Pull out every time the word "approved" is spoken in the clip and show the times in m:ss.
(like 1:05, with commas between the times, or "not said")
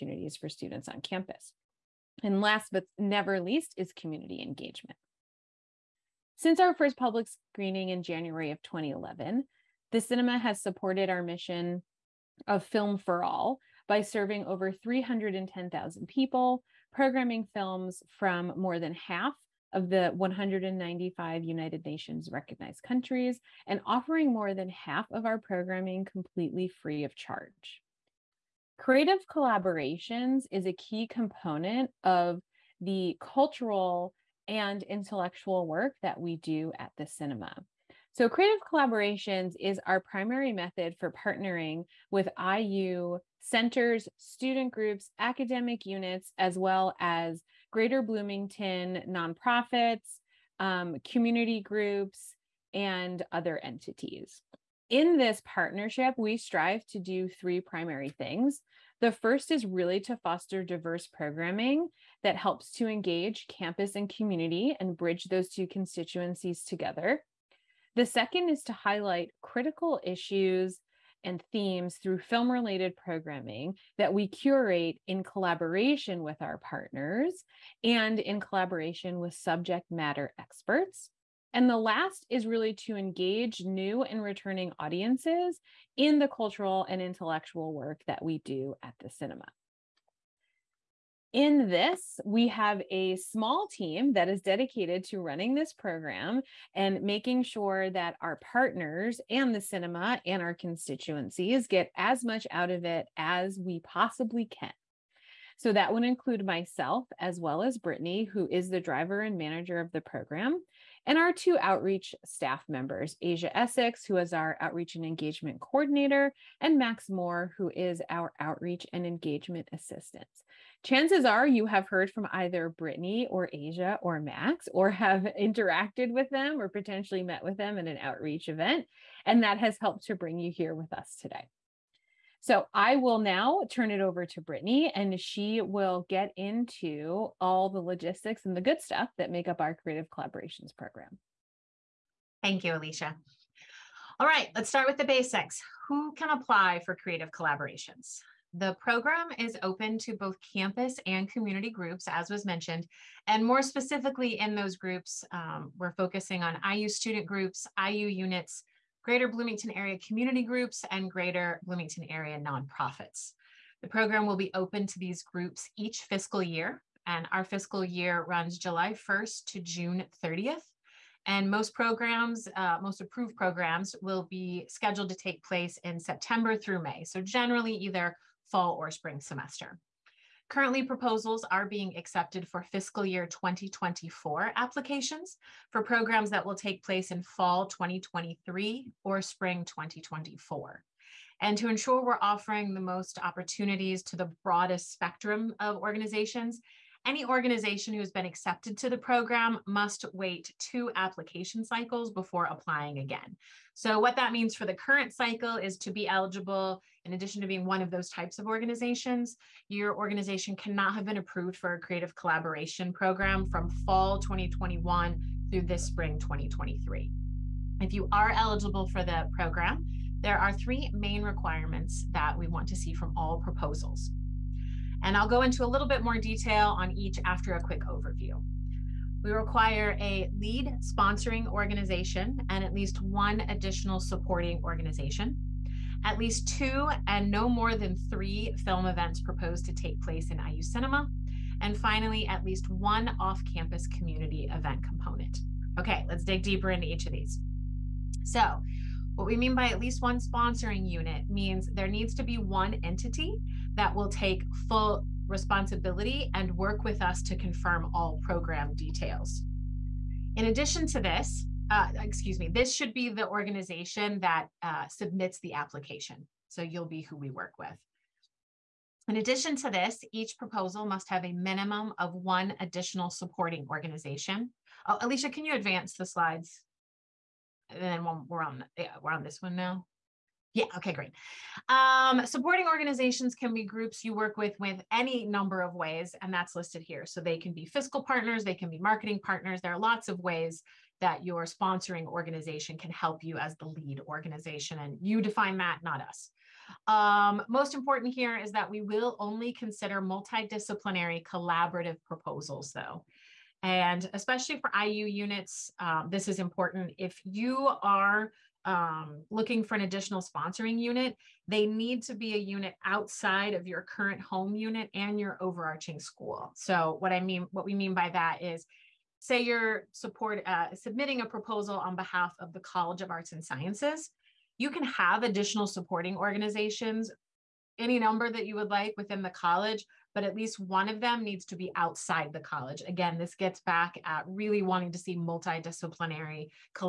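2:53, 3:31.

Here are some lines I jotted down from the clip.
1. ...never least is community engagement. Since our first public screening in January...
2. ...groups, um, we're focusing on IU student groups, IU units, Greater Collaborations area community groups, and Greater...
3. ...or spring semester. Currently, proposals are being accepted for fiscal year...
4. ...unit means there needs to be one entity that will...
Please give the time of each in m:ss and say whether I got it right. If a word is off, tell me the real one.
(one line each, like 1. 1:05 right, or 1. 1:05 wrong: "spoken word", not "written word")
1. 0:02 right
2. 2:34 wrong: "Bloomington", not "Collaborations"
3. 2:58 right
4. 4:10 right.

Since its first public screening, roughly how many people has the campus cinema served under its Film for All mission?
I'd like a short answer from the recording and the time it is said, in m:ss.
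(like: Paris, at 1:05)
310,000, at 0:14.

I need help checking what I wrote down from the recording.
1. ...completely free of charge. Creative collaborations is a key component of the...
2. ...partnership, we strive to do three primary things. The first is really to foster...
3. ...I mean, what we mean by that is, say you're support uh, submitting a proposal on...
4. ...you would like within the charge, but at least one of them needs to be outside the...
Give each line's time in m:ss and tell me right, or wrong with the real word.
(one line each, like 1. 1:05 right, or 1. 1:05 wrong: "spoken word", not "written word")
1. 0:26 right
2. 0:55 right
3. 5:17 right
4. 5:28 wrong: "college", not "charge".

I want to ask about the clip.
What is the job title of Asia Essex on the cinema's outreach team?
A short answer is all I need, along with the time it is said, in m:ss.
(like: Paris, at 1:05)
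Outreach and engagement coordinator, at 1:54.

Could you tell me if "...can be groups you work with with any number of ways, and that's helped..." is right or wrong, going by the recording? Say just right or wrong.
wrong.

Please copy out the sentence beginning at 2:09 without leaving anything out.
And that has helped to bring you here with us today.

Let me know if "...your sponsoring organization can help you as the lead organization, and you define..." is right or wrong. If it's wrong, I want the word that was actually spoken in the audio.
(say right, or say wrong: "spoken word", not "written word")
right.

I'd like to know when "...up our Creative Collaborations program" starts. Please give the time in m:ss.
2:19.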